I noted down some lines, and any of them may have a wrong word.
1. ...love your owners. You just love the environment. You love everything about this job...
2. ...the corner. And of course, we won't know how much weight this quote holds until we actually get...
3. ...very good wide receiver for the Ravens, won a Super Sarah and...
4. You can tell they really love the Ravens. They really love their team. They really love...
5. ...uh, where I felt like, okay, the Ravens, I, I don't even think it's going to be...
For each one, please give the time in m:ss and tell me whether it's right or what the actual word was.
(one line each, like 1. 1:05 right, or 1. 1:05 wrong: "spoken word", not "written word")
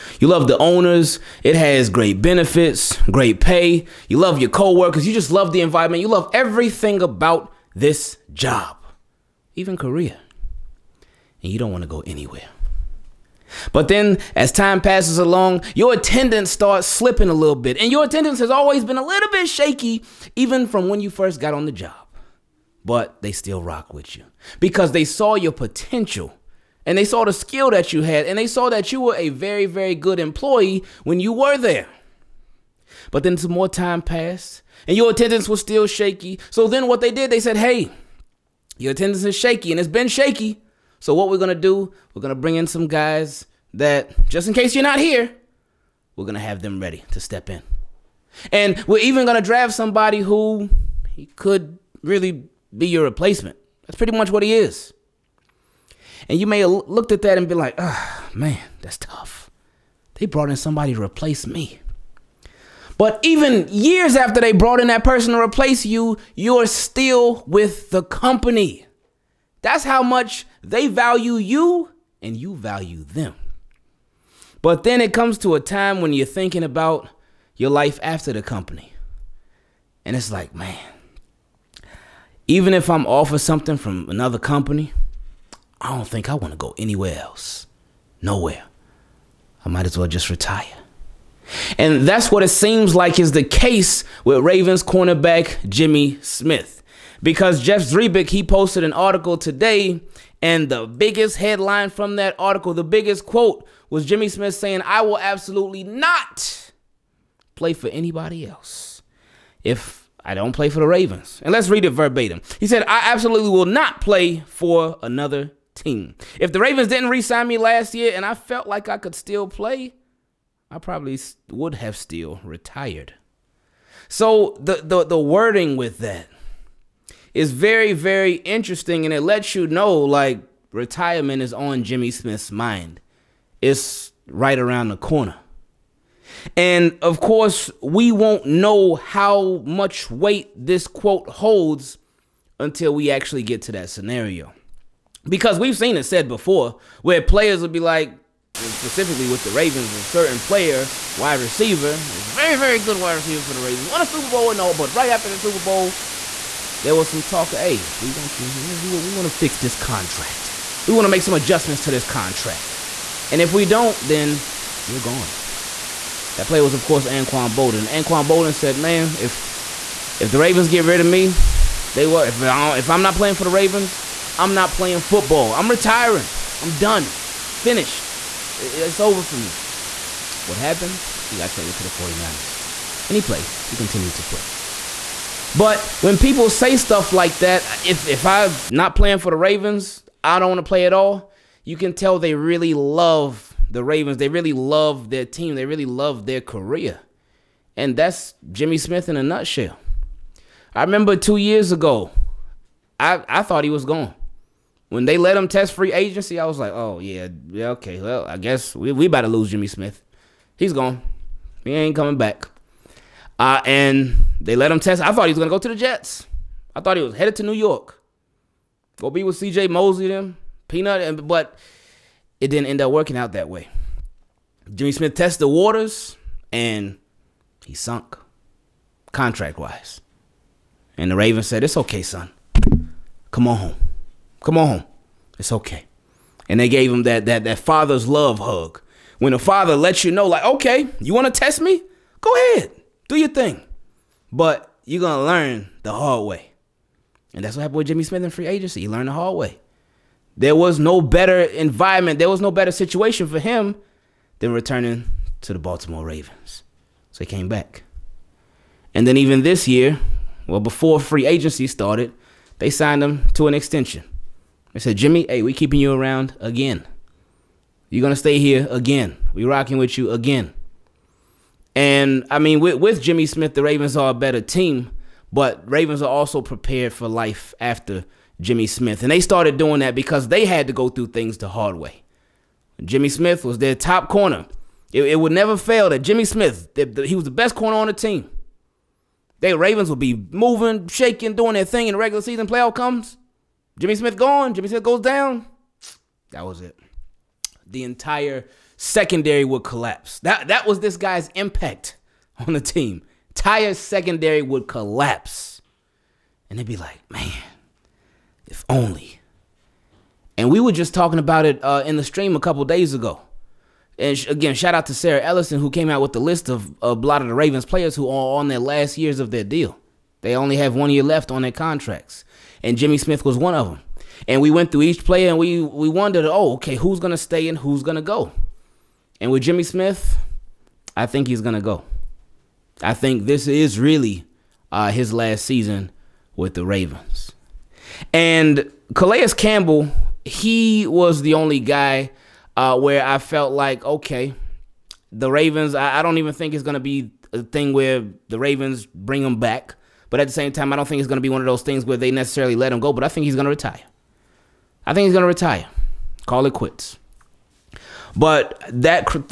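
1. 0:04 wrong: "coworkers", not "owners"
2. 2:14 right
3. 2:32 wrong: "Bowl", not "Sarah"
4. 3:11 right
5. 5:42 right.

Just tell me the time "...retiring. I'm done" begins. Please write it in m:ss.
2:55.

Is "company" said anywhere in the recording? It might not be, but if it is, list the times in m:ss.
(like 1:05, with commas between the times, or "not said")
1:08, 1:18, 1:24.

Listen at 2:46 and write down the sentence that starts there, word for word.
That player was, of course, Anquan Boldin.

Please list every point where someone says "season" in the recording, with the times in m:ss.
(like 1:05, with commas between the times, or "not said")
4:52, 5:35.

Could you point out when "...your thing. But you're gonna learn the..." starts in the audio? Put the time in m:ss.
4:03.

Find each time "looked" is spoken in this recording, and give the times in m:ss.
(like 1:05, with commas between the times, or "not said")
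0:56.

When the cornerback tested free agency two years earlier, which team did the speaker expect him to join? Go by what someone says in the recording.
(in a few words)
Jets.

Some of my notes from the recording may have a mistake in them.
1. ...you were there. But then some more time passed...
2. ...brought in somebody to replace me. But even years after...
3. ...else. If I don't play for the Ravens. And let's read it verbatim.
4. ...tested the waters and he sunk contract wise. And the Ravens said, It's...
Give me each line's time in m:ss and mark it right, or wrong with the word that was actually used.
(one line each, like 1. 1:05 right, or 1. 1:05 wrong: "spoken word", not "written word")
1. 0:31 right
2. 1:00 right
3. 1:48 right
4. 3:45 right.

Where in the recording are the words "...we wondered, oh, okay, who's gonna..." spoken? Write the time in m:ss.
5:25.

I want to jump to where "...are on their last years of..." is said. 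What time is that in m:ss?
5:18.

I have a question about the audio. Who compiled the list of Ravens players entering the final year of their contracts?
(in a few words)
Sarah Ellison.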